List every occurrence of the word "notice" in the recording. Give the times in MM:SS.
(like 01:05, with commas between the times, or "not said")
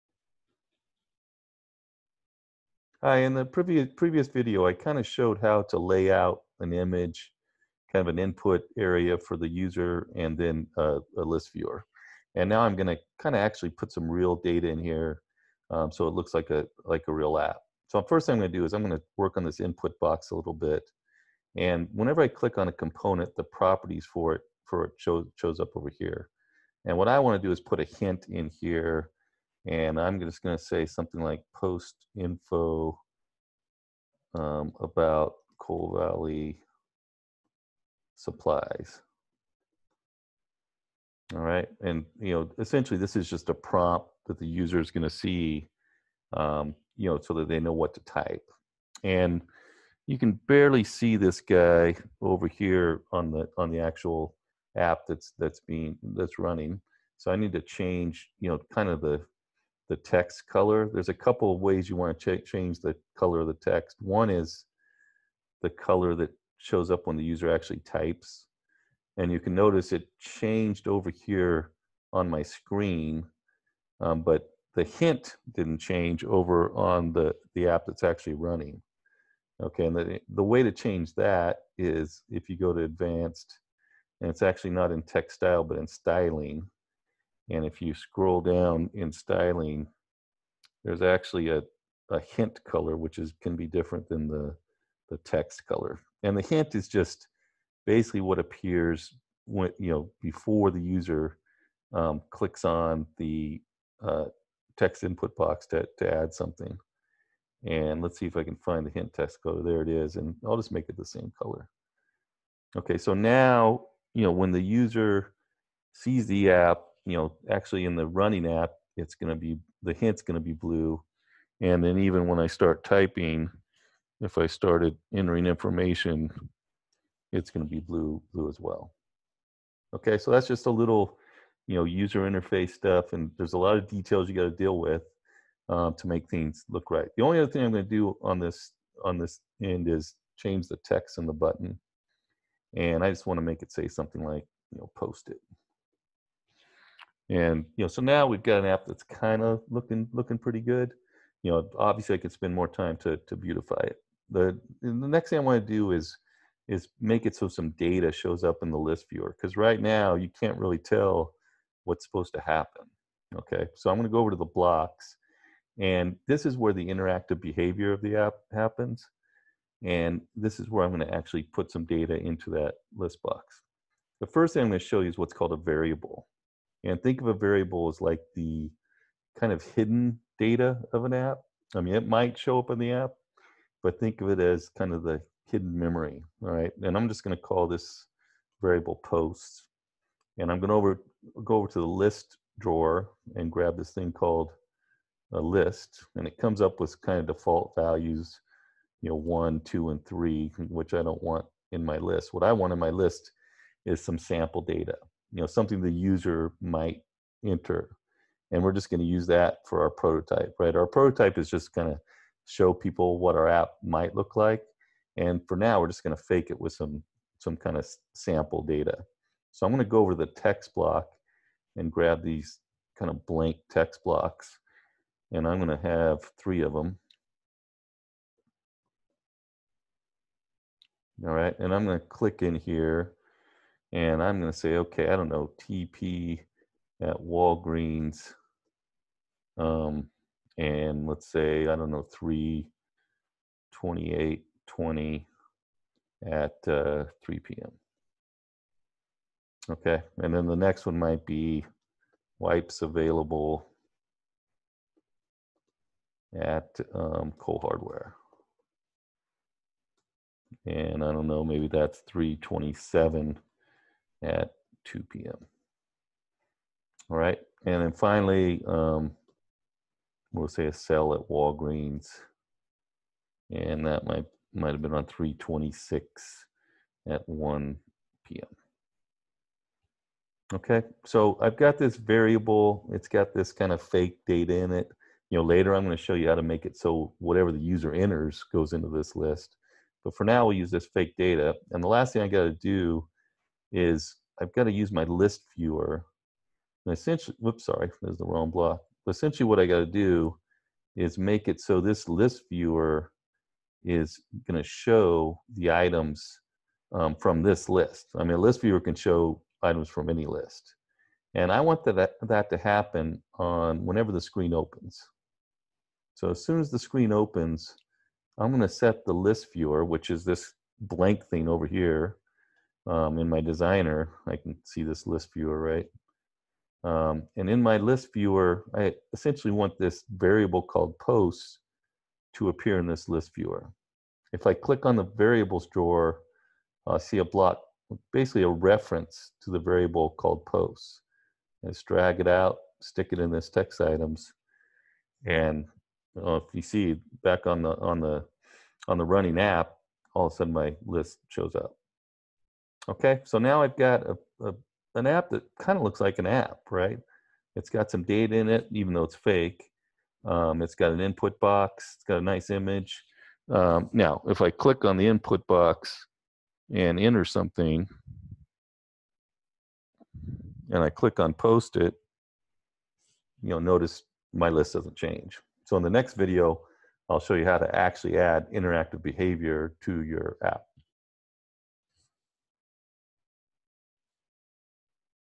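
01:09, 06:13.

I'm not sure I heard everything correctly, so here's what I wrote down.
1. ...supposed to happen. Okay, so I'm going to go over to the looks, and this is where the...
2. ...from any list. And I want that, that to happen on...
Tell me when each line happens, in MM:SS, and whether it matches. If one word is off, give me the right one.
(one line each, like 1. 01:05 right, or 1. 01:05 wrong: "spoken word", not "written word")
1. 02:42 wrong: "blocks", not "looks"
2. 05:09 right.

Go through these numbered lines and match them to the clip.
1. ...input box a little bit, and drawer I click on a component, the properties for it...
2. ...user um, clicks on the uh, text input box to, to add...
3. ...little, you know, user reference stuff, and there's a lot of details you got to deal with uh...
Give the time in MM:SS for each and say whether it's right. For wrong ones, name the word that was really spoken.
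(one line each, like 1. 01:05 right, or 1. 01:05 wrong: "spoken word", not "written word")
1. 00:19 wrong: "whenever", not "drawer"
2. 01:40 right
3. 02:10 wrong: "interface", not "reference".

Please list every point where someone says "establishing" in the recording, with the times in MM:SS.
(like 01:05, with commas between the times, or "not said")
not said.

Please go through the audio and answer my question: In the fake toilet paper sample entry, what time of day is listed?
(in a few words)
3 p.m.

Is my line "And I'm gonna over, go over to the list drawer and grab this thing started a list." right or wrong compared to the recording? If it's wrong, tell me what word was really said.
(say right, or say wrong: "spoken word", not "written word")
wrong: "called", not "started".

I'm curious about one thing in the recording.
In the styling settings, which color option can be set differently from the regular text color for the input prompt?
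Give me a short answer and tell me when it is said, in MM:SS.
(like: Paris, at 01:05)
hint color, at 01:32.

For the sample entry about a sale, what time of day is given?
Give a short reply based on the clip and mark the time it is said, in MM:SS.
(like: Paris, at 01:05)
1 p.m., at 04:37.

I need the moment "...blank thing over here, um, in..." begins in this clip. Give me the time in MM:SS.
05:20.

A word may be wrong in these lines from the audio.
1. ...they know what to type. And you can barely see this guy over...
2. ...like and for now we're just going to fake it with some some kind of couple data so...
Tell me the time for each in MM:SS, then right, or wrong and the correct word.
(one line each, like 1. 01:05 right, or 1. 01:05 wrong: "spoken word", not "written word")
1. 00:47 right
2. 03:34 wrong: "sample", not "couple".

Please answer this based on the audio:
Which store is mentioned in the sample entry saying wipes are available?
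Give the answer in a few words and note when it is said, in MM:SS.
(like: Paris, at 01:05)
Cole Hardware, at 04:17.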